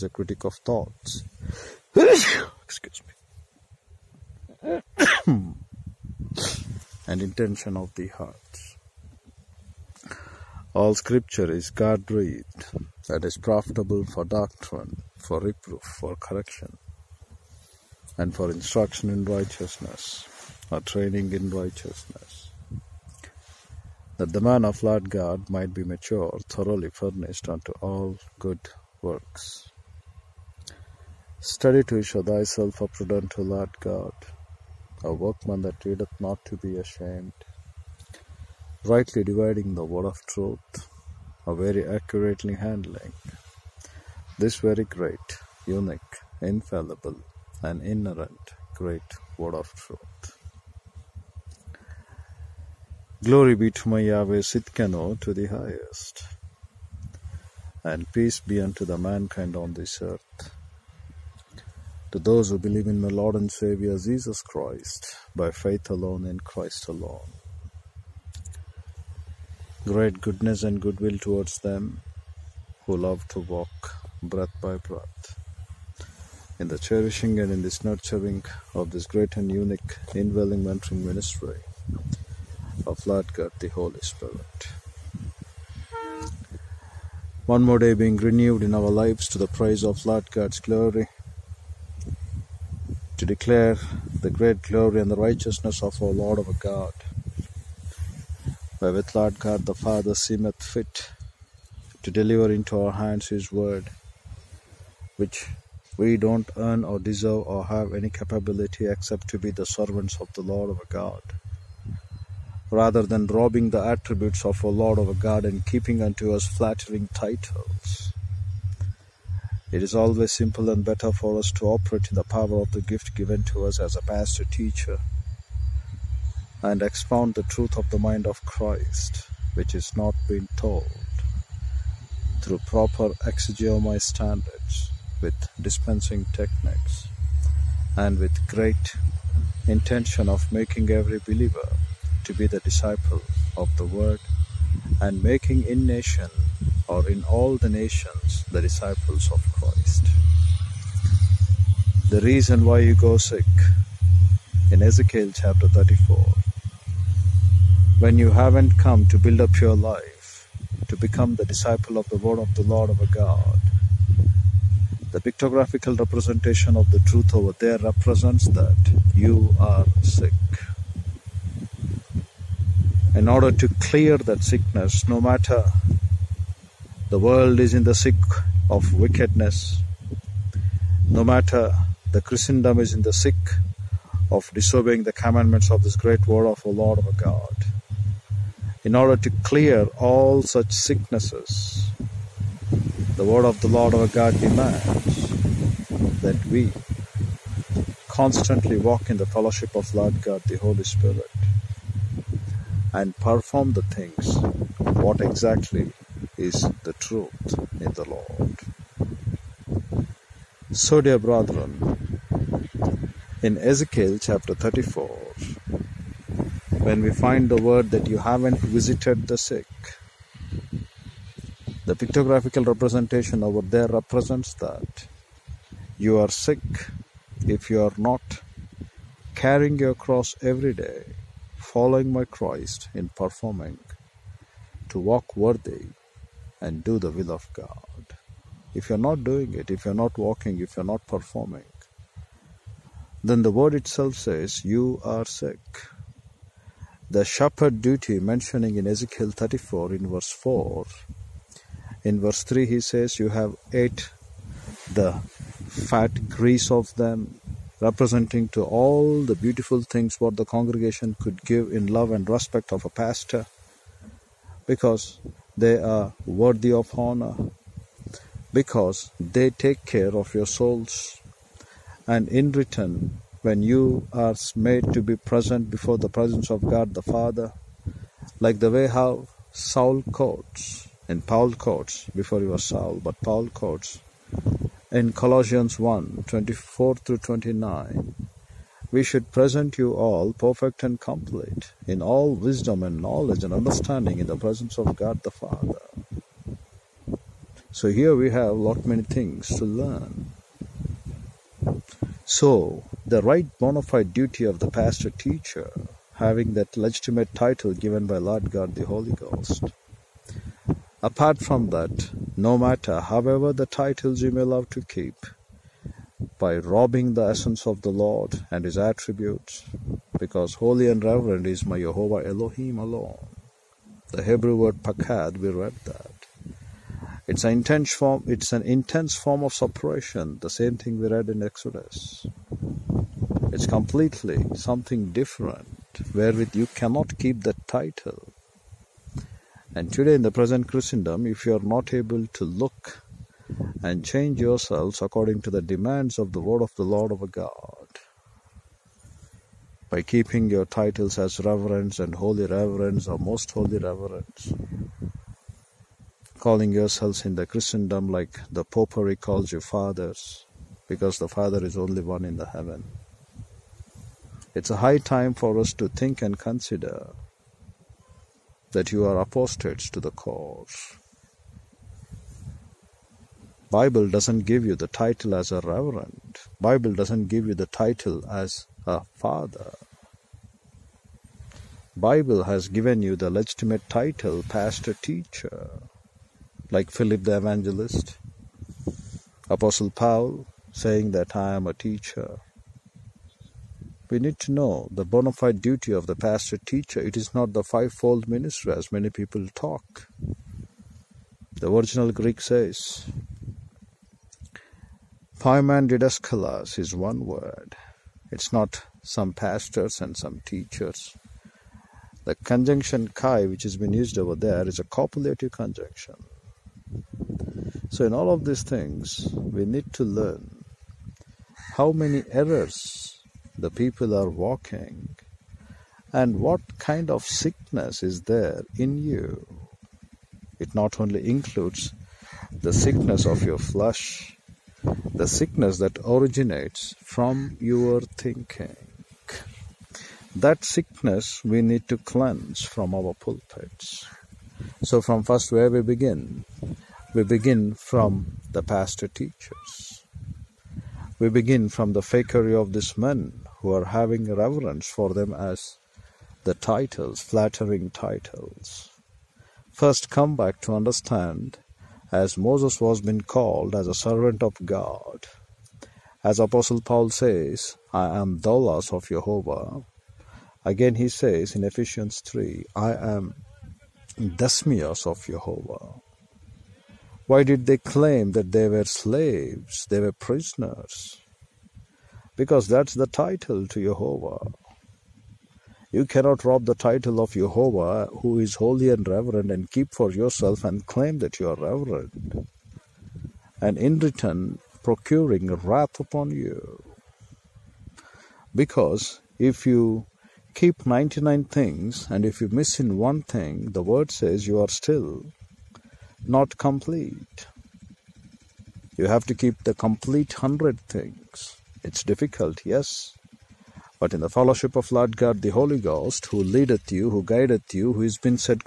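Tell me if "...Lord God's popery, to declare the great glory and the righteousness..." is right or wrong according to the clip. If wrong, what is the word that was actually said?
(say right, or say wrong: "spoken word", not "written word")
wrong: "glory", not "popery".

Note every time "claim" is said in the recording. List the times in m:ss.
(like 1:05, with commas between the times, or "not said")
7:57, 8:10.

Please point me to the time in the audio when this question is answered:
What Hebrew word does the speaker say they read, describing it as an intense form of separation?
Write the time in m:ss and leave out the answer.
5:24.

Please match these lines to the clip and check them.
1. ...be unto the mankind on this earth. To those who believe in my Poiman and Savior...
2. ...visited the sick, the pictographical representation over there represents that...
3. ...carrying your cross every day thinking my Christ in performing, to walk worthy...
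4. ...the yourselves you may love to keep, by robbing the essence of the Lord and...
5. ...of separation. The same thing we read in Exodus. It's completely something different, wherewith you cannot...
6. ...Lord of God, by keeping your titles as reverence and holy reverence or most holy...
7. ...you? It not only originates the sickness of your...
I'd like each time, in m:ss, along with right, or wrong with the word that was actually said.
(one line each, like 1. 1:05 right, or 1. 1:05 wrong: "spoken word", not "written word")
1. 0:58 wrong: "Lord", not "Poiman"
2. 3:38 right
3. 3:49 wrong: "following", not "thinking"
4. 5:13 wrong: "titles", not "yourselves"
5. 5:29 right
6. 5:46 right
7. 7:09 wrong: "includes", not "originates".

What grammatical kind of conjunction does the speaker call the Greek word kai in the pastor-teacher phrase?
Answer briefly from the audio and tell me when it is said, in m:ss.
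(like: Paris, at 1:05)
copulative, at 6:54.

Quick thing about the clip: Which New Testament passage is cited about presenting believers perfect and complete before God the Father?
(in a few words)
Colossians 1:24-29.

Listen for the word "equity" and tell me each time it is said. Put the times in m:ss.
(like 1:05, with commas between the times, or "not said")
not said.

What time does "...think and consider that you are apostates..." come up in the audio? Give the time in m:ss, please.
6:05.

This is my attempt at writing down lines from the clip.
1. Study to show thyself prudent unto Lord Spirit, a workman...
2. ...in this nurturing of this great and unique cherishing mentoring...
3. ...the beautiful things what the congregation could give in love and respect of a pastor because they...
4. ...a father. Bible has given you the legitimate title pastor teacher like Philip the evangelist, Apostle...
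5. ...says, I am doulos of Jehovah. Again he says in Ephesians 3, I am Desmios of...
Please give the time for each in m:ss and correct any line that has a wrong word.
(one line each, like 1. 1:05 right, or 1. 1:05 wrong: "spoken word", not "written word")
1. 0:31 wrong: "God", not "Spirit"
2. 1:17 wrong: "indwelling", not "cherishing"
3. 4:19 right
4. 6:18 right
5. 7:47 right.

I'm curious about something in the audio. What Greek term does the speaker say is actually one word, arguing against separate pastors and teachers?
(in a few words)
Poiman didaskalos.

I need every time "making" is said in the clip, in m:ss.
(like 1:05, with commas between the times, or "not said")
2:20, 2:25.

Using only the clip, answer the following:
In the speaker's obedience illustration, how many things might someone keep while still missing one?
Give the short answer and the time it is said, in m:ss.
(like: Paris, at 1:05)
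99, at 8:20.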